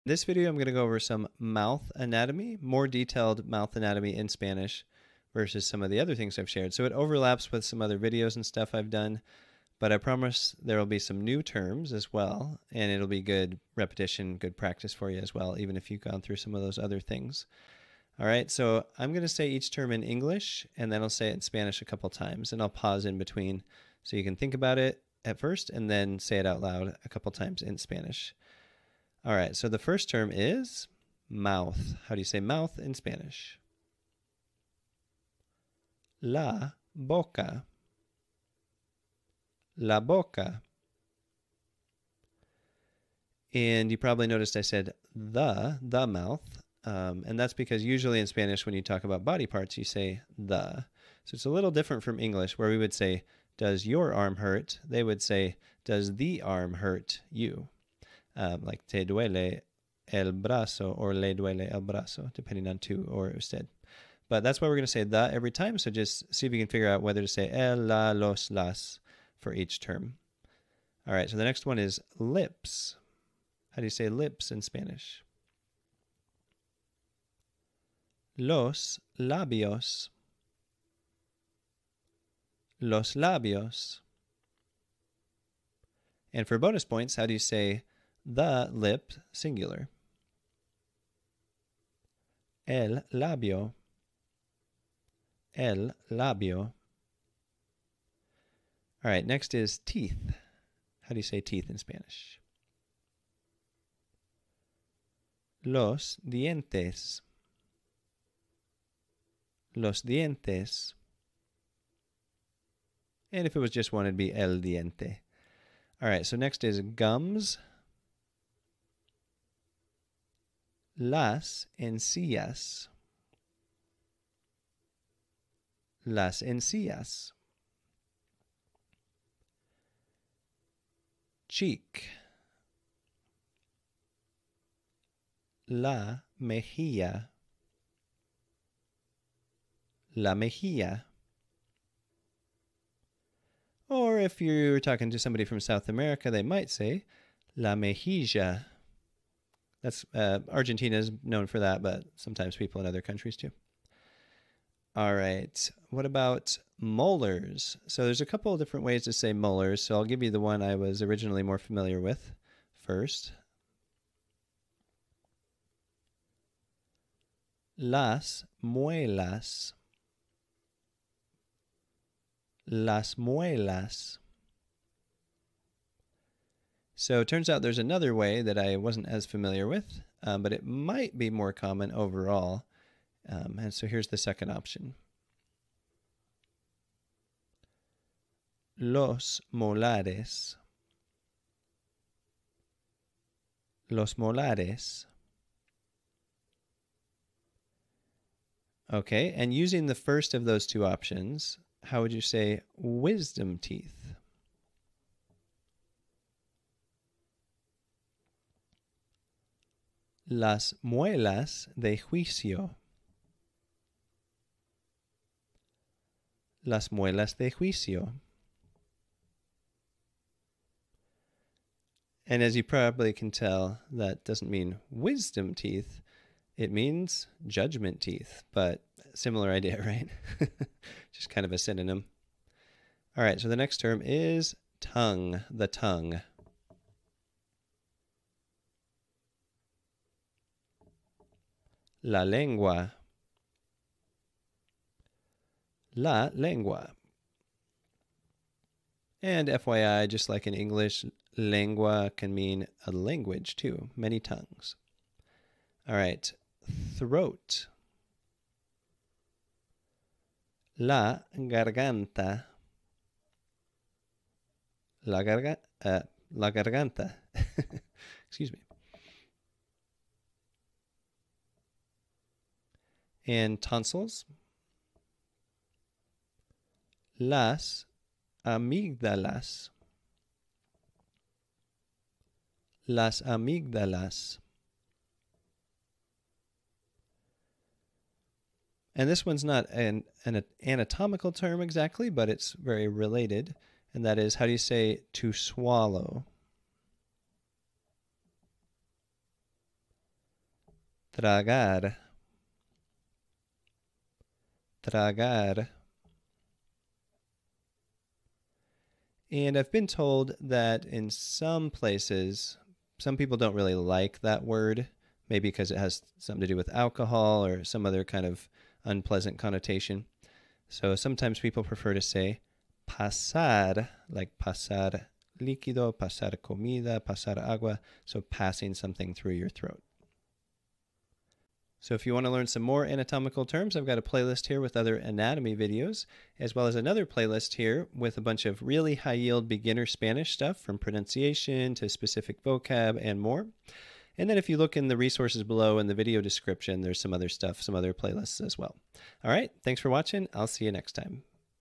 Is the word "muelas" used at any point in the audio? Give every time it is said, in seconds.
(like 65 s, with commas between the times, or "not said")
168 s, 173 s, 210 s, 216 s.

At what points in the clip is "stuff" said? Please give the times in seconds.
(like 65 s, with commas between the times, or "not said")
8 s, 340 s, 347 s.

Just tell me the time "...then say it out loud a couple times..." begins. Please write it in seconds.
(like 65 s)
25 s.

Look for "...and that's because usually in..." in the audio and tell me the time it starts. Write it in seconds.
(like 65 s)
47 s.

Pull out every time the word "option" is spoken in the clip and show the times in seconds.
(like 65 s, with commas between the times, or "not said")
184 s, 200 s.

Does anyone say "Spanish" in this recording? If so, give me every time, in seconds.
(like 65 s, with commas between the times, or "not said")
4 s, 21 s, 27 s, 32 s, 48 s, 74 s, 101 s, 339 s.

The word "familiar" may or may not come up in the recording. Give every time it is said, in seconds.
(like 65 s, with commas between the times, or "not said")
161 s, 179 s.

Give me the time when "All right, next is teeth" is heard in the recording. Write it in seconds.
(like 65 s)
99 s.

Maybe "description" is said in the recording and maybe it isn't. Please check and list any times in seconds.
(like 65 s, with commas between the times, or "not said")
346 s.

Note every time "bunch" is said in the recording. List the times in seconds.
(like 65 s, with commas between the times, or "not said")
338 s.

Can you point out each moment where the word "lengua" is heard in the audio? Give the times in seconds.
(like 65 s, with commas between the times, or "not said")
242 s, 246 s, 251 s.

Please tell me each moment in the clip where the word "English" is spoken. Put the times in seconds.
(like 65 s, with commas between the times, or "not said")
20 s, 52 s, 250 s.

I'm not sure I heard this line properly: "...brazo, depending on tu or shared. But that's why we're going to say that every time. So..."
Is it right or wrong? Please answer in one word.
wrong.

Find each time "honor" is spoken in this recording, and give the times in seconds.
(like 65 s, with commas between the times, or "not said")
not said.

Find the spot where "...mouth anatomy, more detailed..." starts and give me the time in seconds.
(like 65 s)
1 s.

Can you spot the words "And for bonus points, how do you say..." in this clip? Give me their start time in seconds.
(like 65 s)
86 s.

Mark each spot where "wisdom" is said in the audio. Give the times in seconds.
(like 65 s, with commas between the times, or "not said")
202 s, 224 s.